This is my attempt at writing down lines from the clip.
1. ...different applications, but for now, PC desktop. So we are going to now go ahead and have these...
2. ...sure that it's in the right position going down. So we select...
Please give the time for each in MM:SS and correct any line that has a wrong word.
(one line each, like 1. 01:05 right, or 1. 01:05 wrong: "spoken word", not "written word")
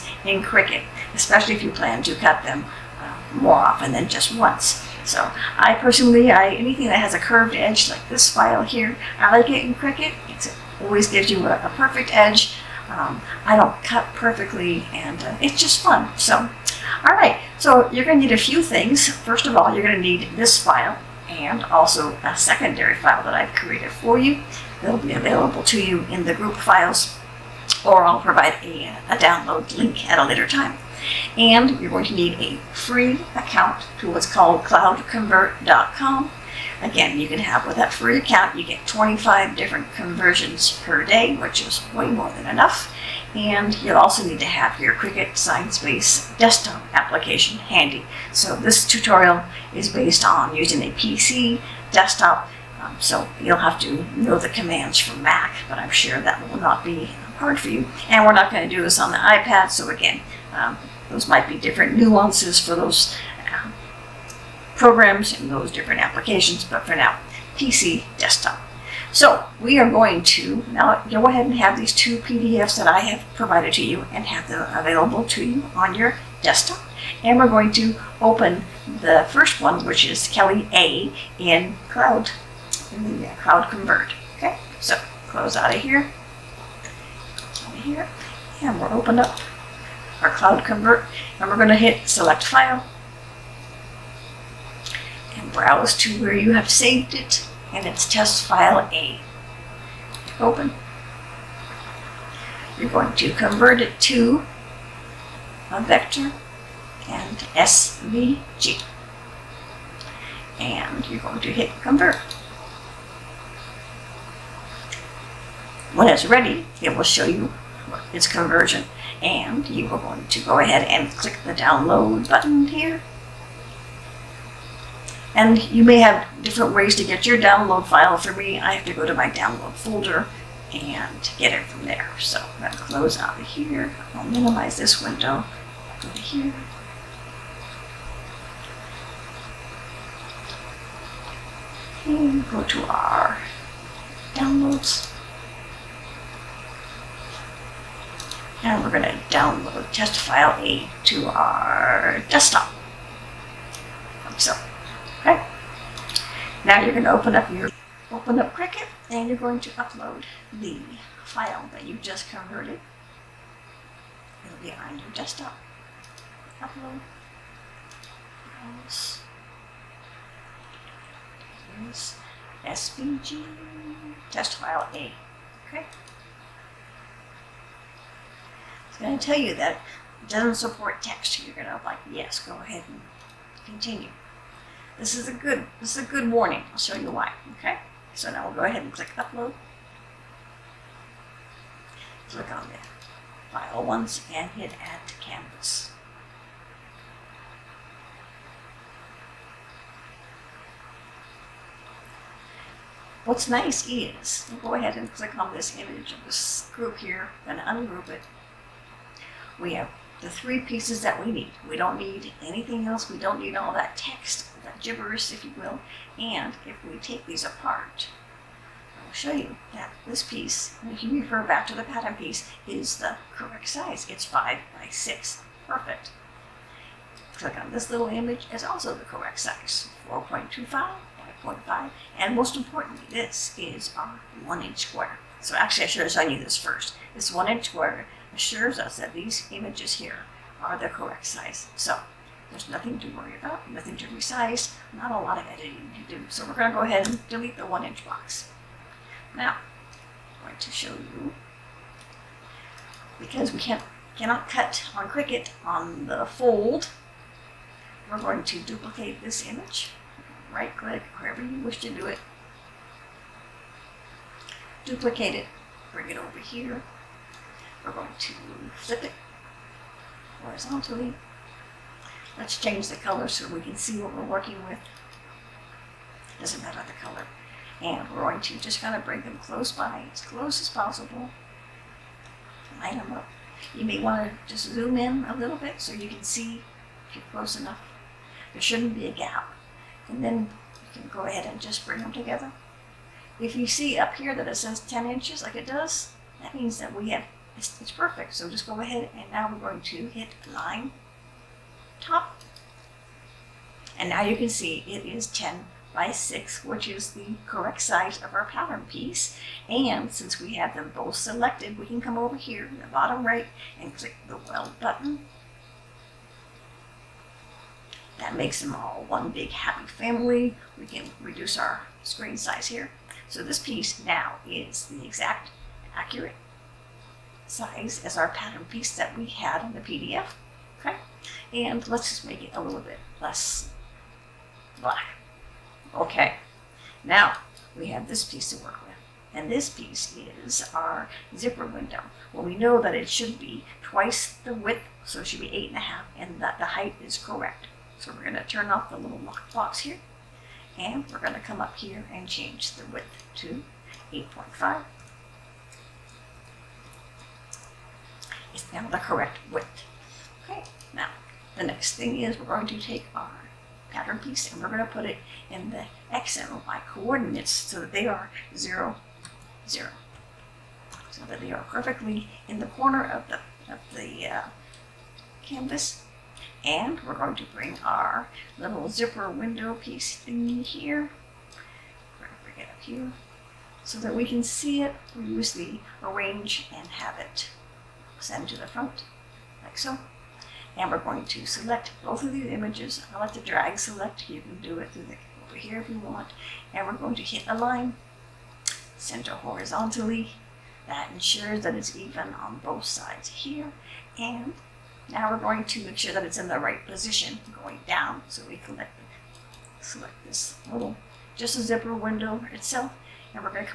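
1. 01:05 right
2. 06:45 right.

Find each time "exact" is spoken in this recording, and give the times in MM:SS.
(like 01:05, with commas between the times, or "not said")
05:25.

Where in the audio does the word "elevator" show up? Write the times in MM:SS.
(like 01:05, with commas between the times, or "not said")
not said.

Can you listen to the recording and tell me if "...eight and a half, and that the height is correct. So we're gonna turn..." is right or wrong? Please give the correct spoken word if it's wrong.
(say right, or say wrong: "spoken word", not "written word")
right.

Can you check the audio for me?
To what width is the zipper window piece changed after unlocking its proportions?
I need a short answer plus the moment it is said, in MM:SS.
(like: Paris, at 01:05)
8.5, at 05:54.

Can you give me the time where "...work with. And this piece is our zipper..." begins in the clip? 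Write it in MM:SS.
05:38.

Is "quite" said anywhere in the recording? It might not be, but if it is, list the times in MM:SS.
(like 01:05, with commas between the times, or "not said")
not said.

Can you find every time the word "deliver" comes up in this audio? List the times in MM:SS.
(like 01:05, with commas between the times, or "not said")
not said.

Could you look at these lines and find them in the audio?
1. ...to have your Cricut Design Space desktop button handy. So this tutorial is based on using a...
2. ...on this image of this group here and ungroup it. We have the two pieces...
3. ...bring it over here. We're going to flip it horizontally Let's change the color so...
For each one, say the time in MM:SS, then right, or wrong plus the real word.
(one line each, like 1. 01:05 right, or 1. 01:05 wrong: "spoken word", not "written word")
1. 00:44 wrong: "application", not "button"
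2. 03:25 wrong: "three", not "two"
3. 04:25 right.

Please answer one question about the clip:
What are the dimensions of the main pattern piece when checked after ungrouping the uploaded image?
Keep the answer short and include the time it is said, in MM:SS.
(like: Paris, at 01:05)
5 by 6, at 03:44.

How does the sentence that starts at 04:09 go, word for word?
Now, I'm going to show you, because we can't, cannot cut on Cricut on the fold, we're going to duplicate this image.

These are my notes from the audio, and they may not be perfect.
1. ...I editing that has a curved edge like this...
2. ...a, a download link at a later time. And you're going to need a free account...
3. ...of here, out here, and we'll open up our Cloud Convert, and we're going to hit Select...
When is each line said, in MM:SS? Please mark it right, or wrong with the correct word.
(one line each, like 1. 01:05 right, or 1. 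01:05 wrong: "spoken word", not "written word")
1. 00:06 wrong: "anything", not "editing"
2. 00:28 right
3. 01:25 right.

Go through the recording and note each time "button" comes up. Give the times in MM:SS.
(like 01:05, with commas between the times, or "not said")
02:02, 05:14.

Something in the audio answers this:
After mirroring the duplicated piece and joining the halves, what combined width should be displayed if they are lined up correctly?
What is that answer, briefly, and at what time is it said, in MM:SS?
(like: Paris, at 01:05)
10 inches, at 04:54.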